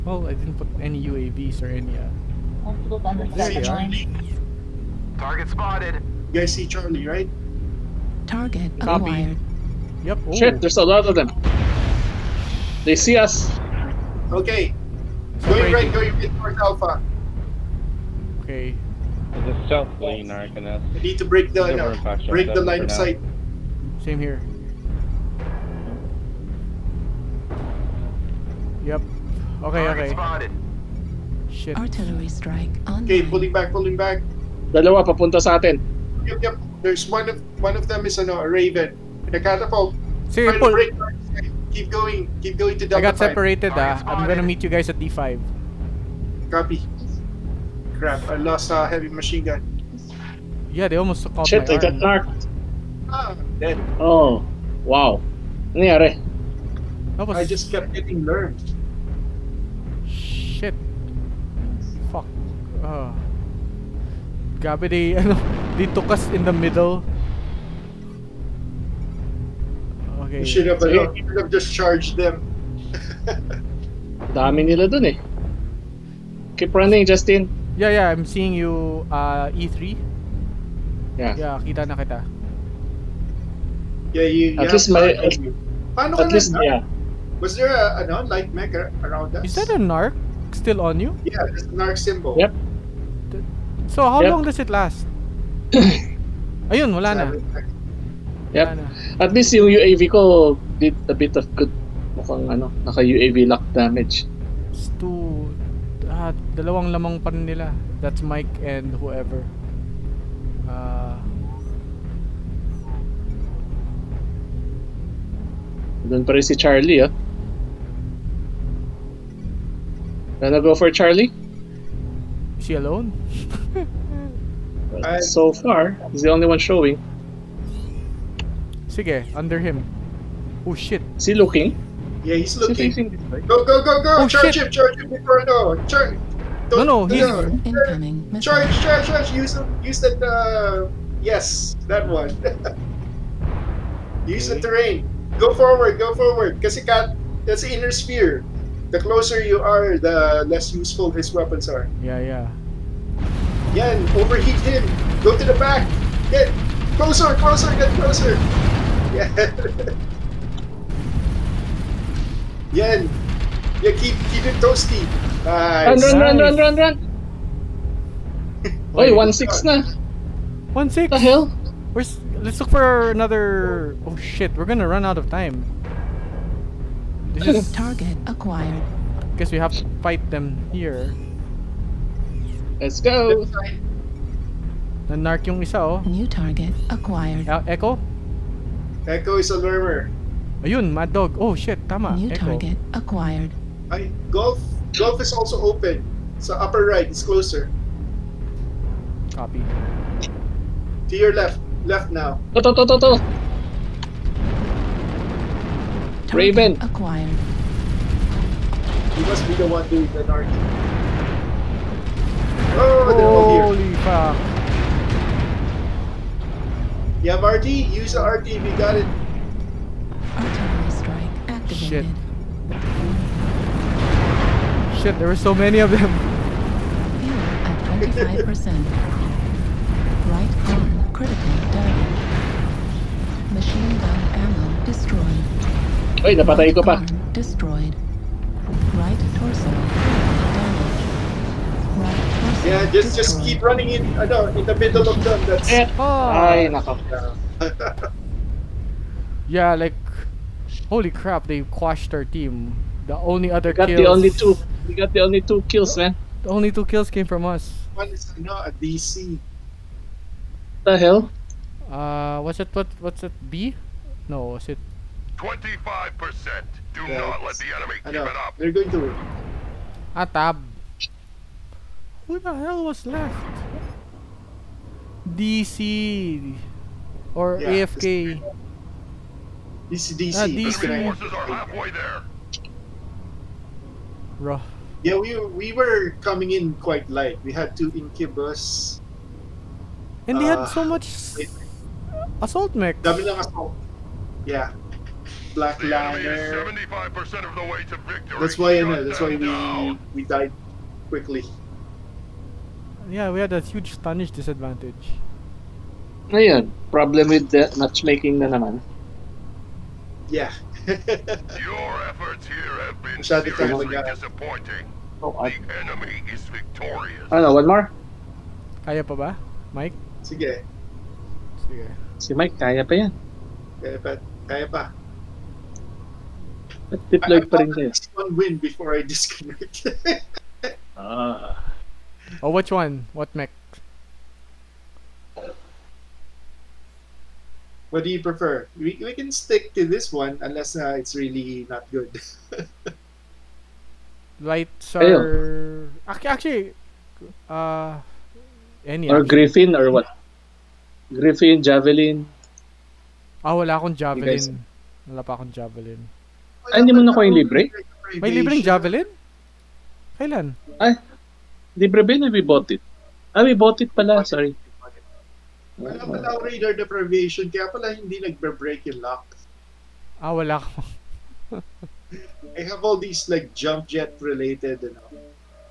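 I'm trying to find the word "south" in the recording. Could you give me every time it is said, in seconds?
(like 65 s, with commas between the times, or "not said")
19 s.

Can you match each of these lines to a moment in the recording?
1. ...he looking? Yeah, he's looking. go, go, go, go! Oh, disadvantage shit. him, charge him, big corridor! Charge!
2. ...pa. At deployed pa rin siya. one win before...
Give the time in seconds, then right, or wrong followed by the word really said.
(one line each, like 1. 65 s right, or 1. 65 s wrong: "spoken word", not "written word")
1. 131 s wrong: "charge", not "disadvantage"
2. 324 s right.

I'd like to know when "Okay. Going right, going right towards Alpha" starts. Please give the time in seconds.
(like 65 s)
14 s.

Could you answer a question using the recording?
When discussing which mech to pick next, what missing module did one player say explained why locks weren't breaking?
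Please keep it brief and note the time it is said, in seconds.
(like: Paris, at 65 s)
radar deprivation, at 366 s.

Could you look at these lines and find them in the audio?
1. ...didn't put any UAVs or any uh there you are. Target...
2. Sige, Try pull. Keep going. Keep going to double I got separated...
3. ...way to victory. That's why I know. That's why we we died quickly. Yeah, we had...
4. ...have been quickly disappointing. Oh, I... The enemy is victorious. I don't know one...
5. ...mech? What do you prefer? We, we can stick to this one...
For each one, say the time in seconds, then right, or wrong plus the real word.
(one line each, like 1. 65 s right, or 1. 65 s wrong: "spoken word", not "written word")
1. 0 s right
2. 40 s right
3. 297 s right
4. 312 s wrong: "seriously", not "quickly"
5. 333 s right.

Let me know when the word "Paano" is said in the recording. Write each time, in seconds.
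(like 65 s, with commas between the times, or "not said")
85 s.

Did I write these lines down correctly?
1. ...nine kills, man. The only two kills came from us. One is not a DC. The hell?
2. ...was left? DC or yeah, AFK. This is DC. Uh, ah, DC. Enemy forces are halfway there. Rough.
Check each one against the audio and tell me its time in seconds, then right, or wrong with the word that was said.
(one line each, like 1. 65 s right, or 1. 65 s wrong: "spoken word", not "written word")
1. 255 s wrong: "two", not "nine"
2. 272 s right.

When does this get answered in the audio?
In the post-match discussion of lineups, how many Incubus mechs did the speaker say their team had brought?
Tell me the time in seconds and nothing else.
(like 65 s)
287 s.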